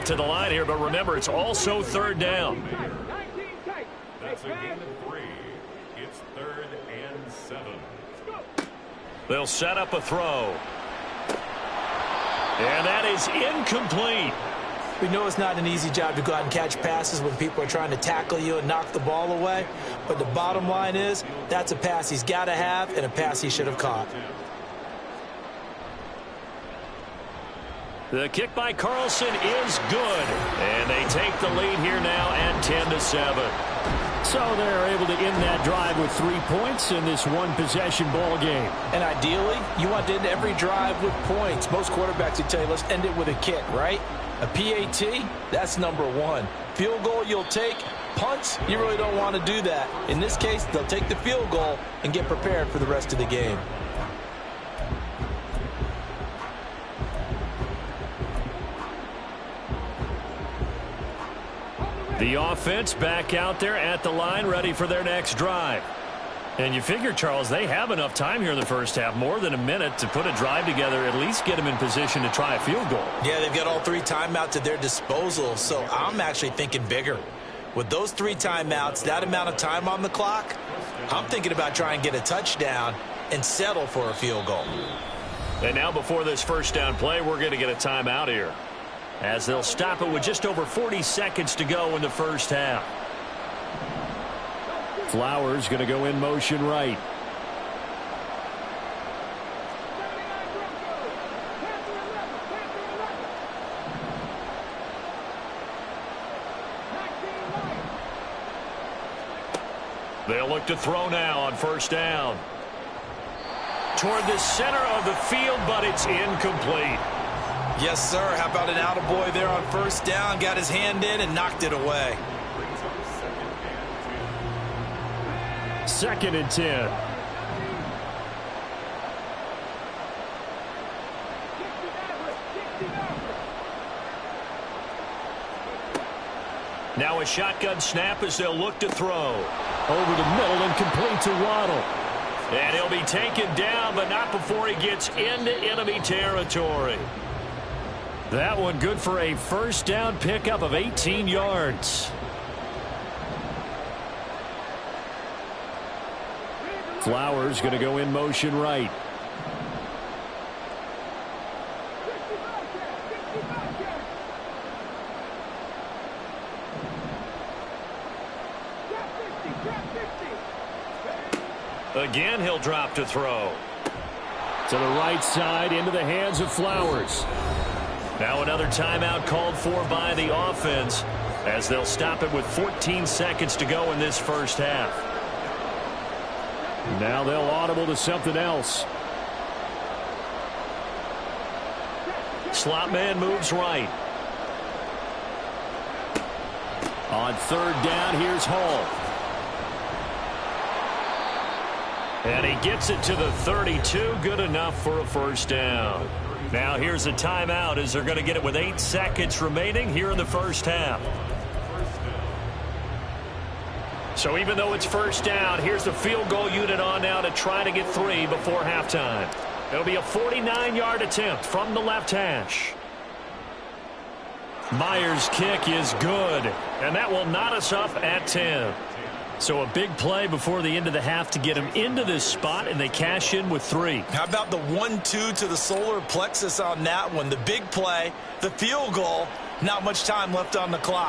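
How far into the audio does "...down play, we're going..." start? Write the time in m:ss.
1:26.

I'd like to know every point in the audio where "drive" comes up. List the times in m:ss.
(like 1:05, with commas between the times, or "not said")
0:35, 0:40, 1:05, 1:10.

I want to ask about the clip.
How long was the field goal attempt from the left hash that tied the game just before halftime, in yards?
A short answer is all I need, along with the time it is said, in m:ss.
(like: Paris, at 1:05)
49, at 3:40.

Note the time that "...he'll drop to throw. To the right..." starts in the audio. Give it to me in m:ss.
2:52.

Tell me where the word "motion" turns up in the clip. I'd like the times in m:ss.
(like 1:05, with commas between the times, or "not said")
1:36, 2:38.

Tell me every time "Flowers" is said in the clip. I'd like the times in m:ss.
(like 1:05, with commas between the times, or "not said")
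1:35, 2:37, 2:56.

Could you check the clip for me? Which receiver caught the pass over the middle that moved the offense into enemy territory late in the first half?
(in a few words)
Waddle.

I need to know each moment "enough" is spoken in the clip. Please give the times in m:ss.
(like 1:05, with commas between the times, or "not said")
1:07, 3:24.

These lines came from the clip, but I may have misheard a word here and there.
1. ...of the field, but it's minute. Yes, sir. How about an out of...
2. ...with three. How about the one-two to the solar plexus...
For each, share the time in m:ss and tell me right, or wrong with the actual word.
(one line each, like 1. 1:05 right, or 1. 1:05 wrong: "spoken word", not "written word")
1. 1:54 wrong: "incomplete", not "minute"
2. 3:53 right.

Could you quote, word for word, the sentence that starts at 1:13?
Yeah, they've got all three timeouts at their disposal, so I'm actually thinking bigger.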